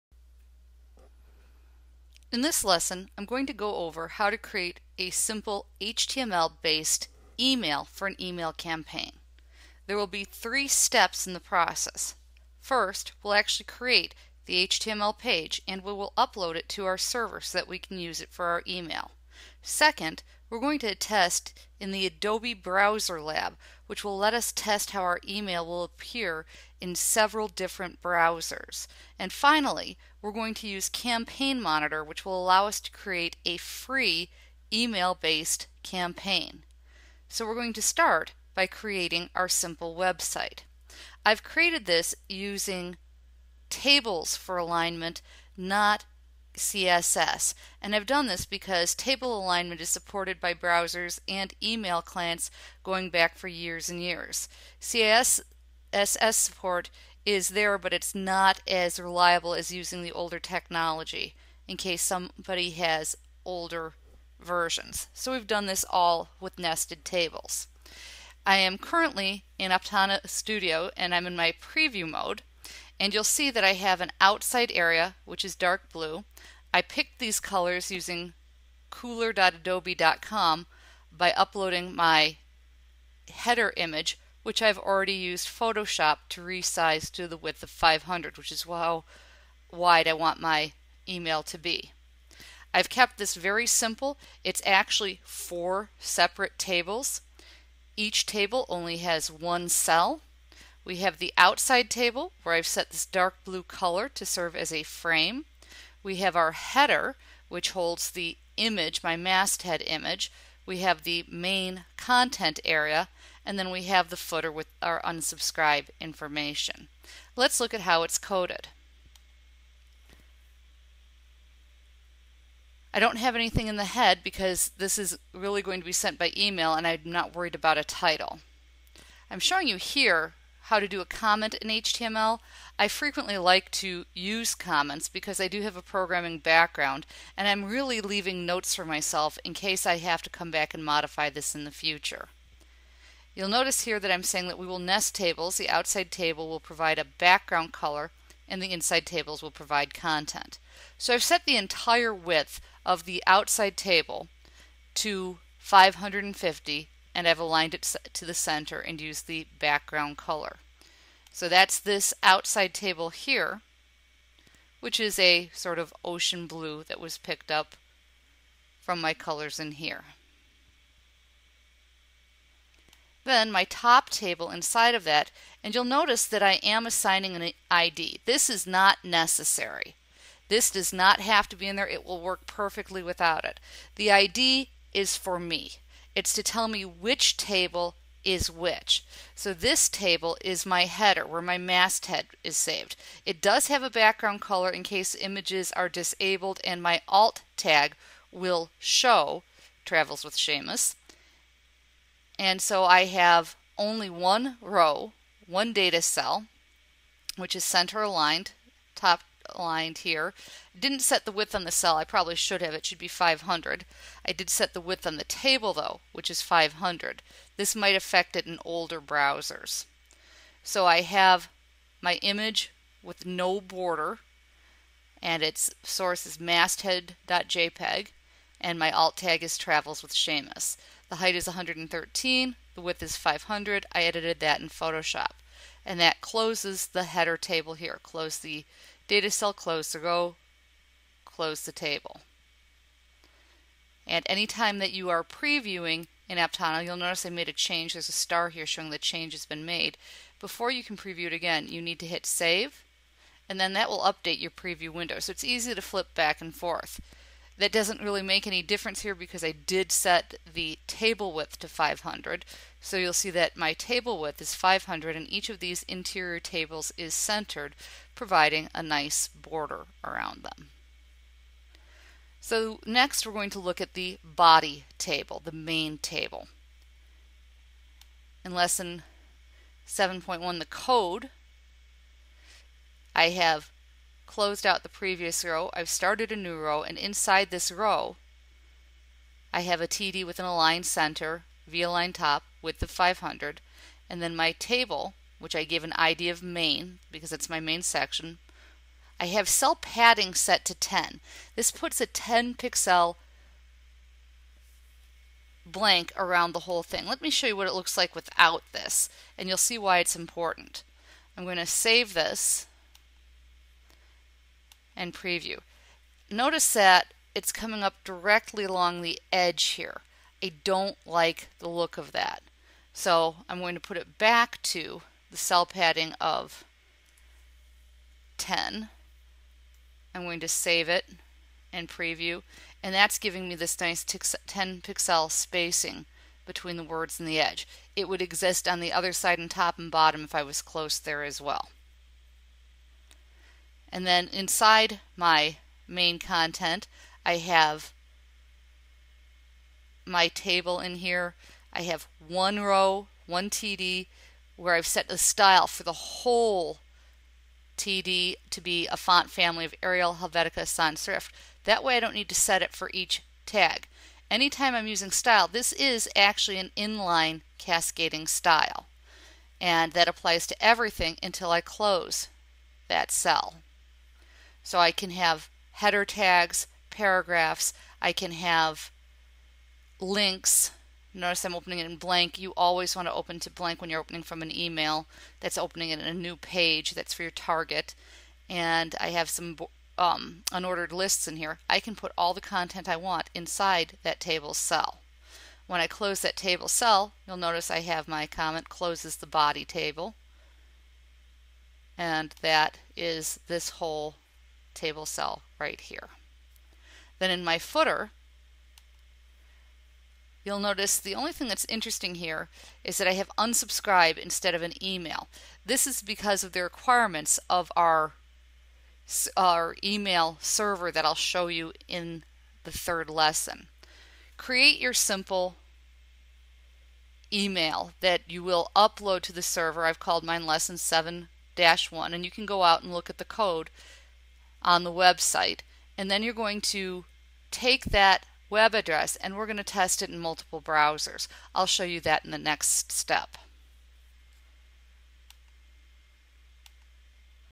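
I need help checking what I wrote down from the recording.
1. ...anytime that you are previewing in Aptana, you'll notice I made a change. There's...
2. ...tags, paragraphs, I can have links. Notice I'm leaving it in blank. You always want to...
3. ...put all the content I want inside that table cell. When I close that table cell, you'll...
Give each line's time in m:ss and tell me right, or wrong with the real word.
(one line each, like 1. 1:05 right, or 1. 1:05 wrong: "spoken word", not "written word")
1. 4:04 right
2. 6:16 wrong: "opening", not "leaving"
3. 6:31 right.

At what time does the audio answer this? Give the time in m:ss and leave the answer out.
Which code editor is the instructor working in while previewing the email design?
1:09.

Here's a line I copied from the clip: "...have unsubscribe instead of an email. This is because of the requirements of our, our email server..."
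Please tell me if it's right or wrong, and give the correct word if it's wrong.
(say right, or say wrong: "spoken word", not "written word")
right.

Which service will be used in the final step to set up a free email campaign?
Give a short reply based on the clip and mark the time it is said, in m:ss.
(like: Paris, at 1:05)
Campaign Monitor, at 0:30.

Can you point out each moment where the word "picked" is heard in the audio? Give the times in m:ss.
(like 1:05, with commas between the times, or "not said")
1:16, 2:47.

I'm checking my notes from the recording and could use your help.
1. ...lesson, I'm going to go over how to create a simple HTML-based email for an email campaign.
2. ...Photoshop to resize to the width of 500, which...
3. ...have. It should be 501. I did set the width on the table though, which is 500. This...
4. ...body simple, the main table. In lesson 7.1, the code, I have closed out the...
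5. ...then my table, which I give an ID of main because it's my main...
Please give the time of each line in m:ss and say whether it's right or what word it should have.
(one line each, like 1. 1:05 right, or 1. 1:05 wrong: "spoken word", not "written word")
1. 0:02 right
2. 1:25 right
3. 3:32 wrong: "500", not "501"
4. 4:34 wrong: "table", not "simple"
5. 4:54 right.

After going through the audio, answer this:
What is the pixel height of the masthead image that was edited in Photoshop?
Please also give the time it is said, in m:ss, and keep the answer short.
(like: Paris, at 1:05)
113, at 3:51.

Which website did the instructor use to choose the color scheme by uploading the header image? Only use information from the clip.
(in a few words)
kuler.adobe.com.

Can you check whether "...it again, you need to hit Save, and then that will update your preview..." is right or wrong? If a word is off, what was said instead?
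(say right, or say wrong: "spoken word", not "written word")
right.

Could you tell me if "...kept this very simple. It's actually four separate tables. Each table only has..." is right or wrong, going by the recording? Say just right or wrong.
right.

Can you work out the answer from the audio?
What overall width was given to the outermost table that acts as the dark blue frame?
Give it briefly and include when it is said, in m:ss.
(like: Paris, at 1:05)
550, at 2:35.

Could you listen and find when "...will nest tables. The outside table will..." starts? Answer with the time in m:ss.
2:24.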